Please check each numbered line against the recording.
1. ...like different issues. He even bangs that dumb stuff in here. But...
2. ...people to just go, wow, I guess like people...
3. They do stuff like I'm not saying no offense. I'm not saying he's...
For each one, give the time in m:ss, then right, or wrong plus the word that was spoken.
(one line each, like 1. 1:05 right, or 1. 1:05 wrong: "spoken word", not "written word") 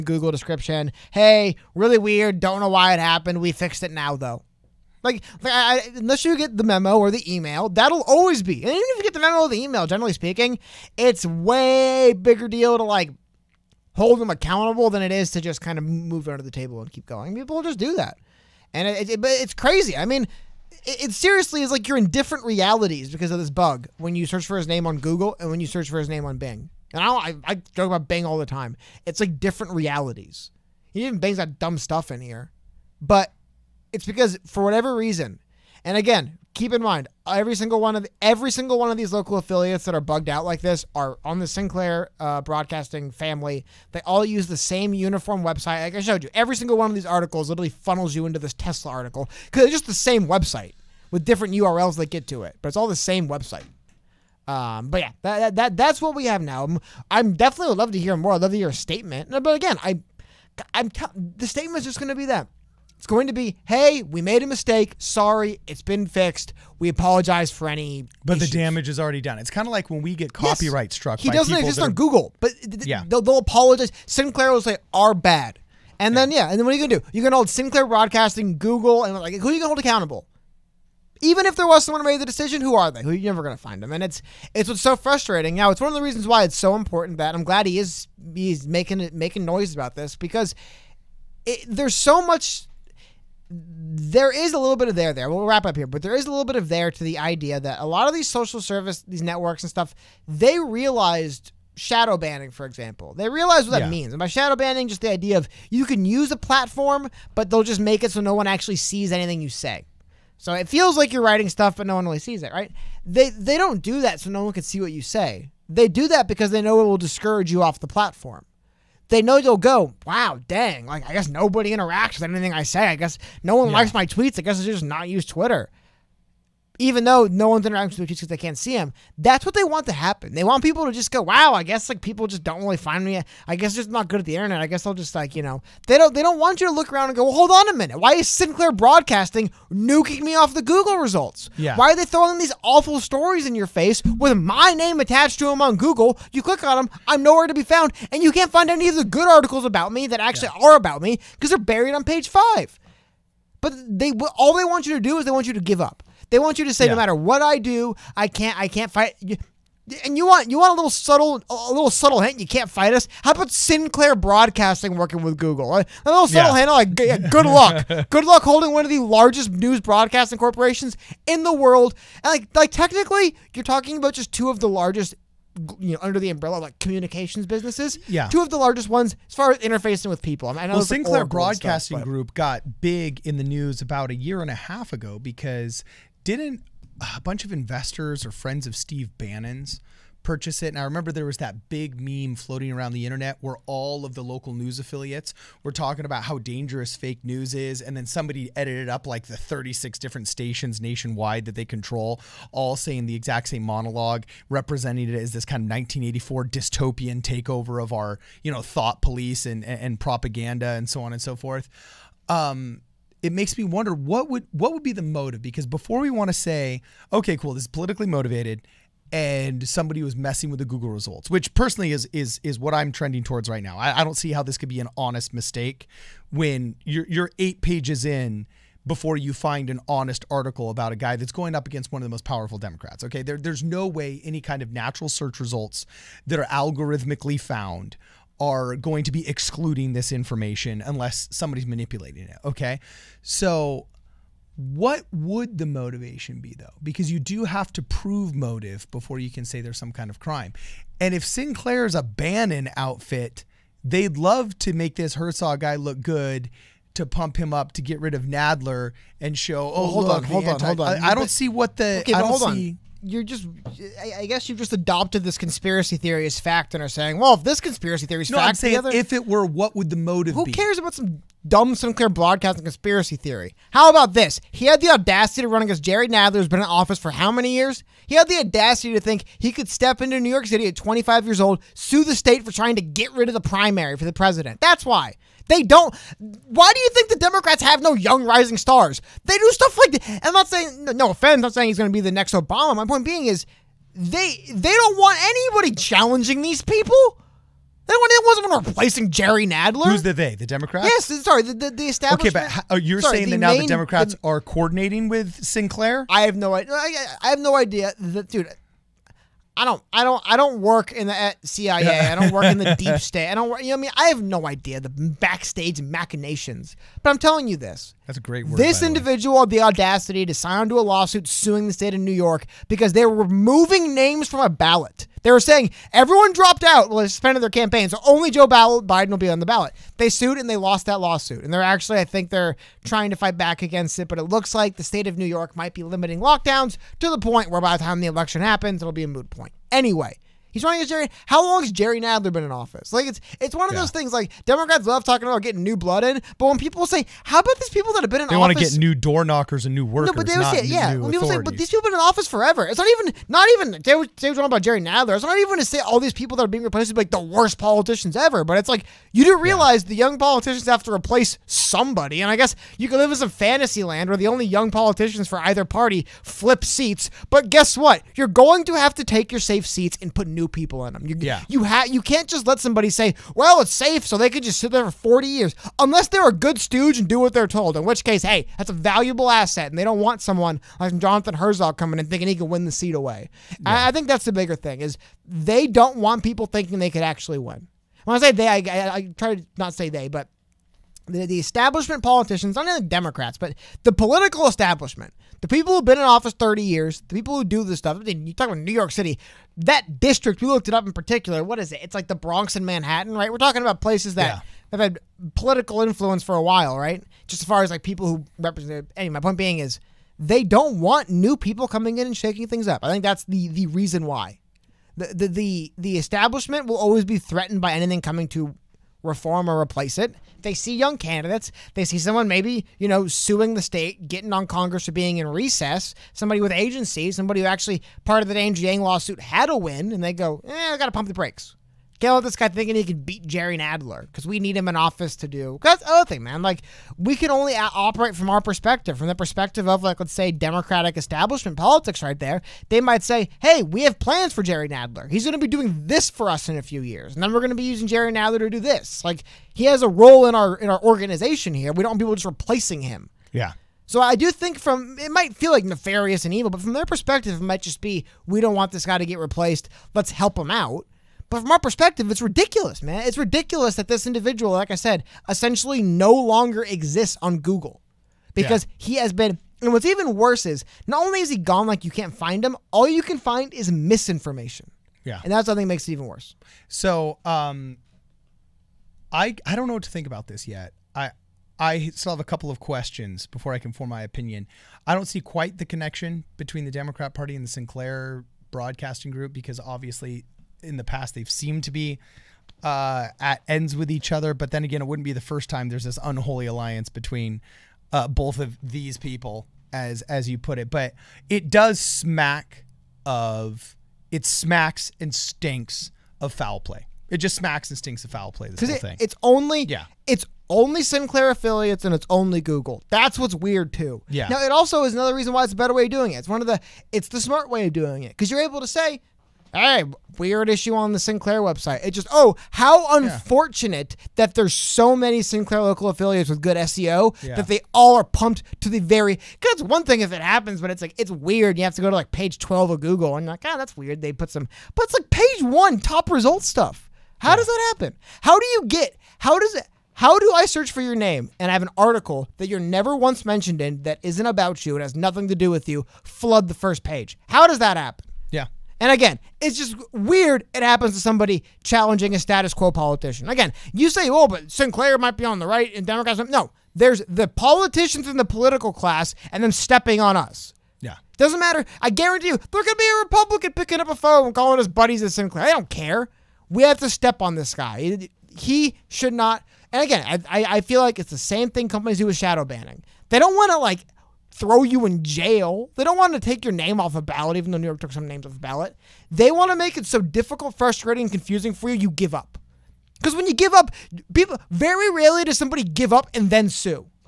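1. 0:29 wrong: "realities", not "issues"
2. 2:10 right
3. 4:49 right.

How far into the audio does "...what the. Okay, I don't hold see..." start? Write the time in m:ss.
4:21.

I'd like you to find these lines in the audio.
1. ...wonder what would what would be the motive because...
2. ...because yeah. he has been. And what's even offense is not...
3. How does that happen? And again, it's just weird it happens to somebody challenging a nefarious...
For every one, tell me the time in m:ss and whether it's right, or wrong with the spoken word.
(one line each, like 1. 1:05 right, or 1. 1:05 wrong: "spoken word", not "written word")
1. 3:33 right
2. 7:48 wrong: "worse", not "offense"
3. 9:07 wrong: "status", not "nefarious".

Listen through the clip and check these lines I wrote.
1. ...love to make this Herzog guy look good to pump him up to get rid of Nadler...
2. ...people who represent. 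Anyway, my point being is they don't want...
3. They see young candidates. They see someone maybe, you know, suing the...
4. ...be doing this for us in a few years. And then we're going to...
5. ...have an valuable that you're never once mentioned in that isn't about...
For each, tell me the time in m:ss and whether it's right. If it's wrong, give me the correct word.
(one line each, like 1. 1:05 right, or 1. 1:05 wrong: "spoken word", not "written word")
1. 4:14 right
2. 6:47 right
3. 7:00 right
4. 7:25 right
5. 9:01 wrong: "article", not "valuable".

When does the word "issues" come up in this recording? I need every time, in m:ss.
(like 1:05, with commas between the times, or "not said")
1:08, 8:40.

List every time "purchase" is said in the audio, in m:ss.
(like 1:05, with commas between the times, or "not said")
3:10.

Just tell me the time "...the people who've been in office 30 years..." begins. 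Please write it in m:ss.
6:35.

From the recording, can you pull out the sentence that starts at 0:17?
People just do that, and it, it, it's crazy.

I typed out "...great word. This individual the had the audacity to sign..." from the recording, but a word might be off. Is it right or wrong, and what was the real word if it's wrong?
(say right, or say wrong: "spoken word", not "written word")
right.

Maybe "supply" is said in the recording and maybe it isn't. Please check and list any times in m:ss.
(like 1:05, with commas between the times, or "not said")
not said.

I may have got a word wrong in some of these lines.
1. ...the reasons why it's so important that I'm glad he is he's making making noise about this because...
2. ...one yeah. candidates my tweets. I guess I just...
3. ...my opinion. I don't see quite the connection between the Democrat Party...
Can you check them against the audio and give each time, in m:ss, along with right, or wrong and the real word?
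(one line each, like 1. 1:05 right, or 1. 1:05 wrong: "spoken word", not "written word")
1. 1:25 right
2. 2:03 wrong: "likes", not "candidates"
3. 8:03 right.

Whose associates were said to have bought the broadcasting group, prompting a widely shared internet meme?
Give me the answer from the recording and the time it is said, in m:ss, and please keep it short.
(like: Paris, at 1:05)
Steve Bannon, at 3:08.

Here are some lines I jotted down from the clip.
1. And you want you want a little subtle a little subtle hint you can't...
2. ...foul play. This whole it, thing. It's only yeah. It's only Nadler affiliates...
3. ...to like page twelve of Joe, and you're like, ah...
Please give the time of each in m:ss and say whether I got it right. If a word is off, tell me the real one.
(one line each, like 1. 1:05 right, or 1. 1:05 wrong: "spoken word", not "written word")
1. 2:40 right
2. 8:28 wrong: "Sinclair", not "Nadler"
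3. 8:51 wrong: "Google", not "Joe".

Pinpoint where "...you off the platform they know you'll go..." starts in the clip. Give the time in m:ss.
1:57.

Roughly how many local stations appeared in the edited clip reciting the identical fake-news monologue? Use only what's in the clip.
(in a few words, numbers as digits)
36.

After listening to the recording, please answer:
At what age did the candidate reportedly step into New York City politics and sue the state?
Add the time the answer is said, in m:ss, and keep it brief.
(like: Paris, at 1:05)
25, at 4:40.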